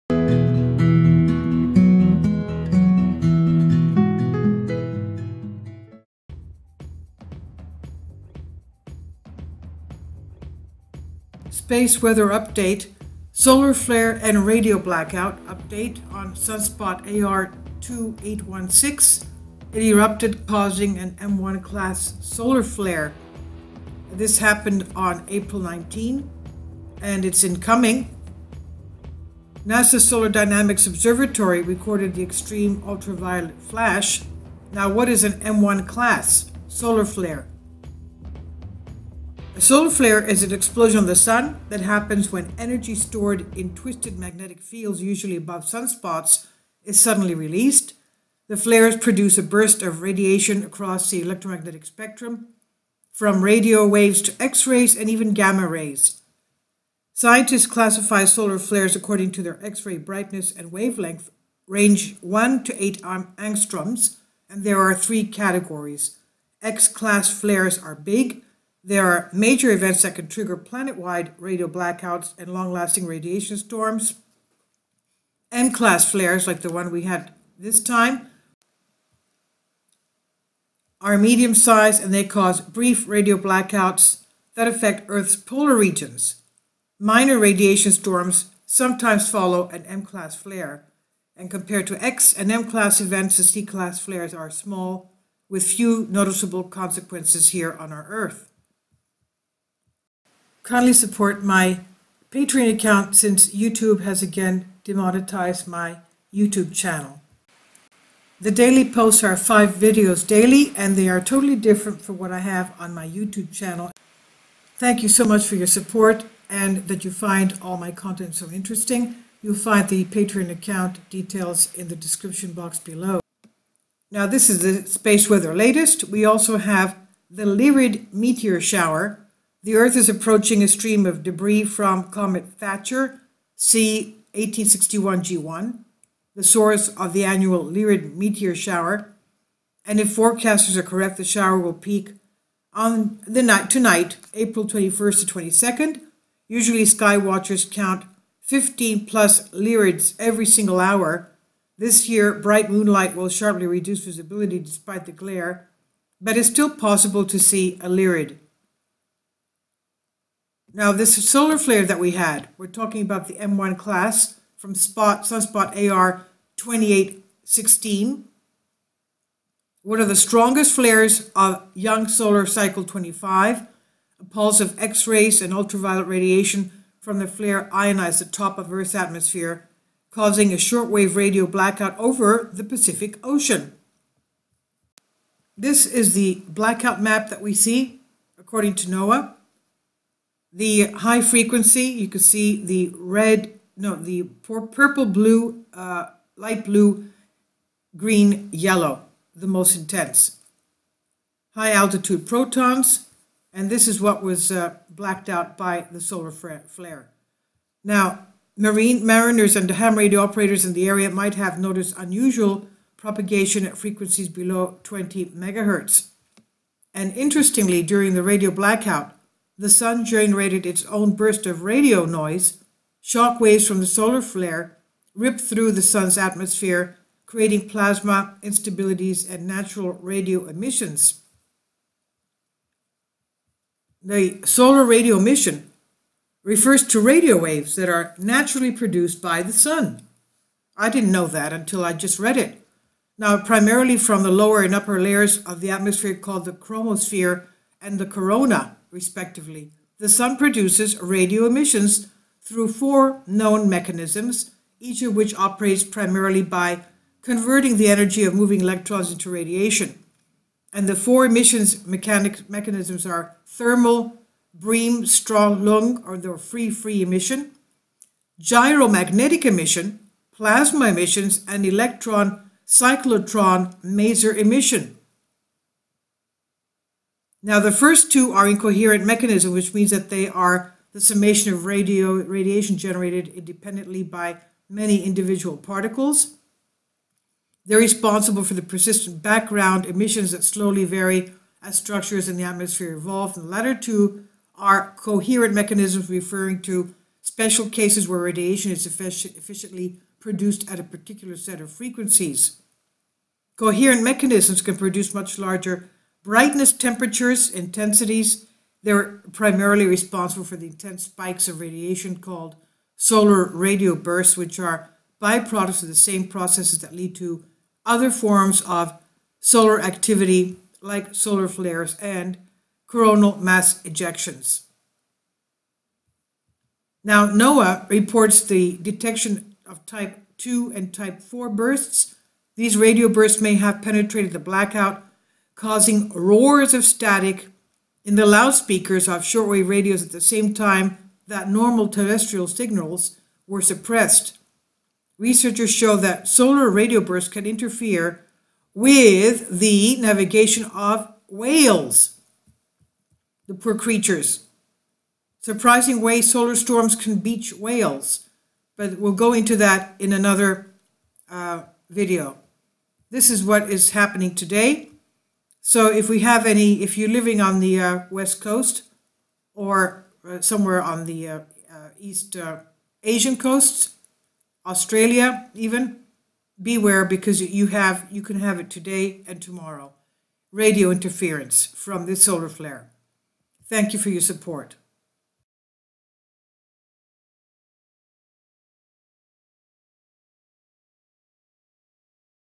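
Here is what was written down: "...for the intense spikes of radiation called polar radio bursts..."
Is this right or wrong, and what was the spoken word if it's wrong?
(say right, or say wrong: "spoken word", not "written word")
wrong: "solar", not "polar".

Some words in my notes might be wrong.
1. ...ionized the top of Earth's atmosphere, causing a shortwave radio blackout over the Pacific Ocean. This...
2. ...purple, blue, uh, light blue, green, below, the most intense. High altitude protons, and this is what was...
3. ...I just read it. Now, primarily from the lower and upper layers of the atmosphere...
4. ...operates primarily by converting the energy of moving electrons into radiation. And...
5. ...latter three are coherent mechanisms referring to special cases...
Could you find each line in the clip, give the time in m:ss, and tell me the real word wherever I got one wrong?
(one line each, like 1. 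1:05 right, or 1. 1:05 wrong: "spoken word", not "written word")
1. 2:57 right
2. 3:14 wrong: "yellow", not "below"
3. 4:01 right
4. 4:15 right
5. 4:53 wrong: "two", not "three".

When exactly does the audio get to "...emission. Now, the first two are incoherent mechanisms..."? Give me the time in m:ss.
4:34.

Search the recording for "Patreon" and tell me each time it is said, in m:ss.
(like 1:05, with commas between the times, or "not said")
1:42, 2:00.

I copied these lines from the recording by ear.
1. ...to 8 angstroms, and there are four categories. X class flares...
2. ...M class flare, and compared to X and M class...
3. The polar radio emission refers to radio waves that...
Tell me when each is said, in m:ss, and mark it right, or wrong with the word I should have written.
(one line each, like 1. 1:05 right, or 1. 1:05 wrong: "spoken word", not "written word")
1. 1:02 wrong: "three", not "four"
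2. 1:29 right
3. 3:54 wrong: "solar", not "polar".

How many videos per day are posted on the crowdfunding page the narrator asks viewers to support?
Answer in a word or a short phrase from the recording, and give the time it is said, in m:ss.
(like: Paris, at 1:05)
5, at 1:49.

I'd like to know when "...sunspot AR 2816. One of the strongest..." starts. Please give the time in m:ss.
2:45.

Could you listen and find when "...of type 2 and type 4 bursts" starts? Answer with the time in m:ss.
5:29.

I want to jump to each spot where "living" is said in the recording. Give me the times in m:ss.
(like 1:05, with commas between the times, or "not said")
6:07.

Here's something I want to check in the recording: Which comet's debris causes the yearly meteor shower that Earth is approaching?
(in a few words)
Comet Thatcher.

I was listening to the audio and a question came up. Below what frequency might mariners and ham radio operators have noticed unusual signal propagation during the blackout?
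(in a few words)
20 megahertz.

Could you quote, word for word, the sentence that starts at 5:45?
Researchers show that solar radio bursts can interfere with the navigation of whales, the poor creatures.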